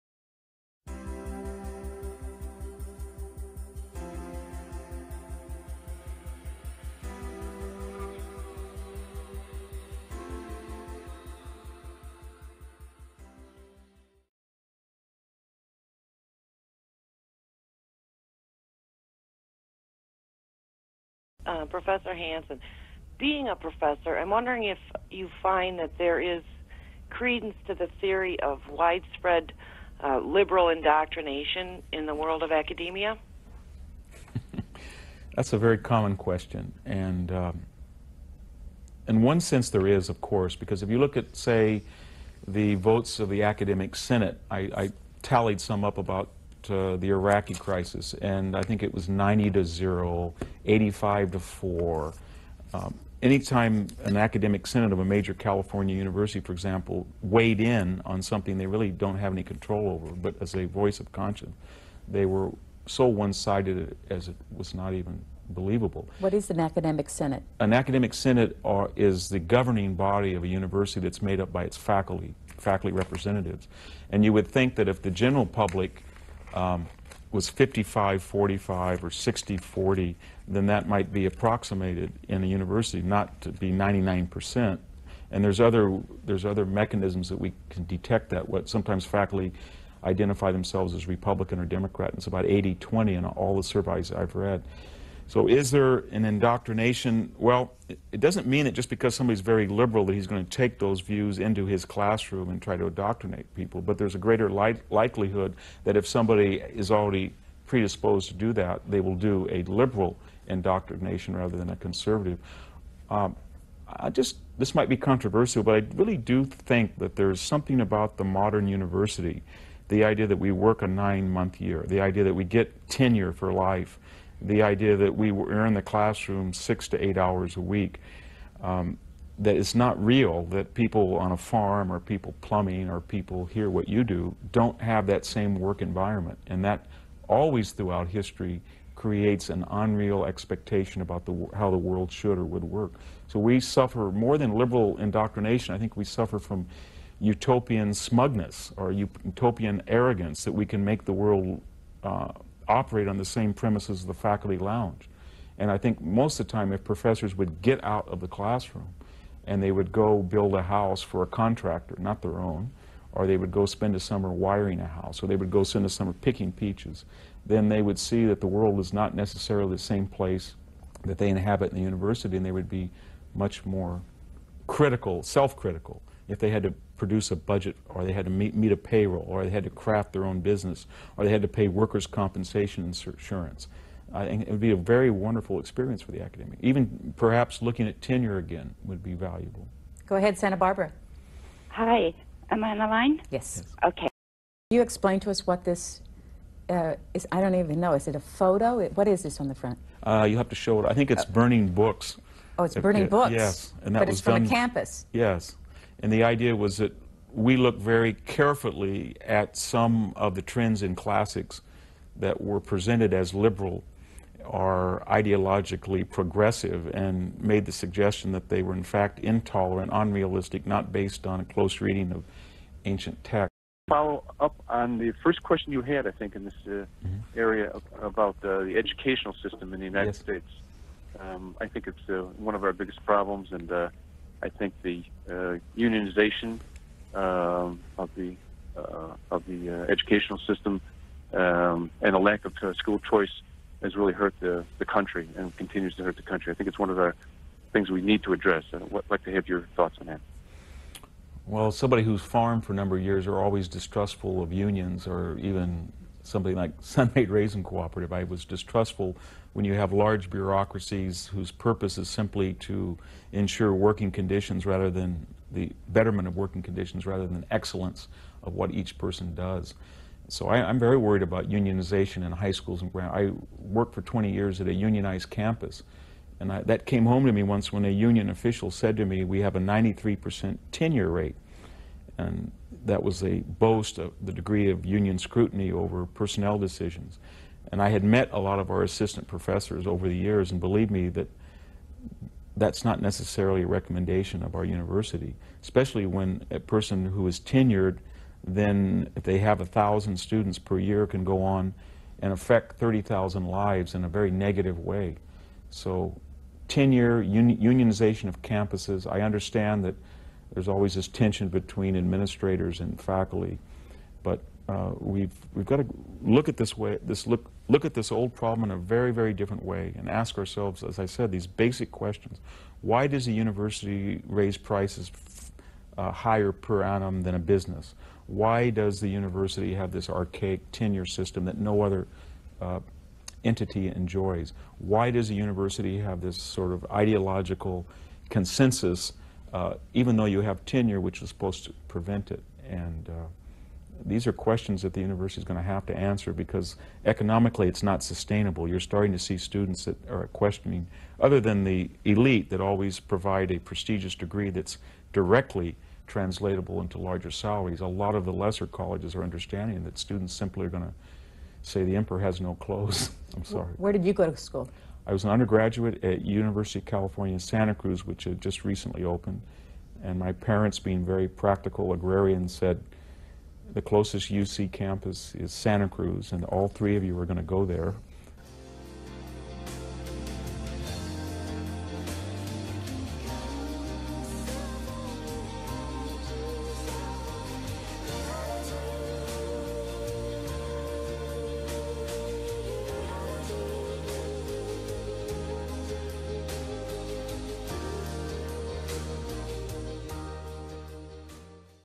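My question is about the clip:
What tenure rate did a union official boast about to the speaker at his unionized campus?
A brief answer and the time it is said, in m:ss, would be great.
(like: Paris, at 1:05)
93%, at 4:39.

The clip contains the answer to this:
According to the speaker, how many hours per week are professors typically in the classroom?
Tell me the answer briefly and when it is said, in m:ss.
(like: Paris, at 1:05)
6 to 8, at 2:06.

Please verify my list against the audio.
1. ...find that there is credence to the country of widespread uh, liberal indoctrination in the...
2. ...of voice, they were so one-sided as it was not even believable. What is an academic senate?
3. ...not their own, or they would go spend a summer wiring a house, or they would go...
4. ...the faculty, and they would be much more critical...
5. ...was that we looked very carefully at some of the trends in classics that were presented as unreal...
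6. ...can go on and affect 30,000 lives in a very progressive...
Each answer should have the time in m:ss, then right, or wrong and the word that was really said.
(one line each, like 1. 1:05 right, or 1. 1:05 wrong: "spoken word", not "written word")
1. 0:25 wrong: "theory", not "country"
2. 1:00 wrong: "conscience", not "voice"
3. 2:41 right
4. 2:51 wrong: "university", not "faculty"
5. 3:26 wrong: "liberal", not "unreal"
6. 5:01 wrong: "negative", not "progressive".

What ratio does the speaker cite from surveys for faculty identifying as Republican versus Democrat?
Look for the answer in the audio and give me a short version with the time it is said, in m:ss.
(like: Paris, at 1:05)
80 20, at 1:32.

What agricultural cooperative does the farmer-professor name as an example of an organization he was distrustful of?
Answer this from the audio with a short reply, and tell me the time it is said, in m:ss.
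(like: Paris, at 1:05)
Sun-Maid Raisin Cooperative, at 4:16.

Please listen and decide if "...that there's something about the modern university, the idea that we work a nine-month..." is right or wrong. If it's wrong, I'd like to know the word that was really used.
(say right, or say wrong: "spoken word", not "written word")
right.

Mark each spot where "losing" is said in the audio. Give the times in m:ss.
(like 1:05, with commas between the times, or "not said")
not said.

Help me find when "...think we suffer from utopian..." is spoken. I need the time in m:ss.
2:25.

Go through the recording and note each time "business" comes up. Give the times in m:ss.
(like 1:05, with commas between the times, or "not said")
3:00, 5:27.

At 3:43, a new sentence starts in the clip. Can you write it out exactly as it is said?
Follow up on the first question you had, I think, in this uh, mm -hmm.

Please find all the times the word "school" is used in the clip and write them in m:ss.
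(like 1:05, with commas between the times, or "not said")
4:02, 4:32, 6:04.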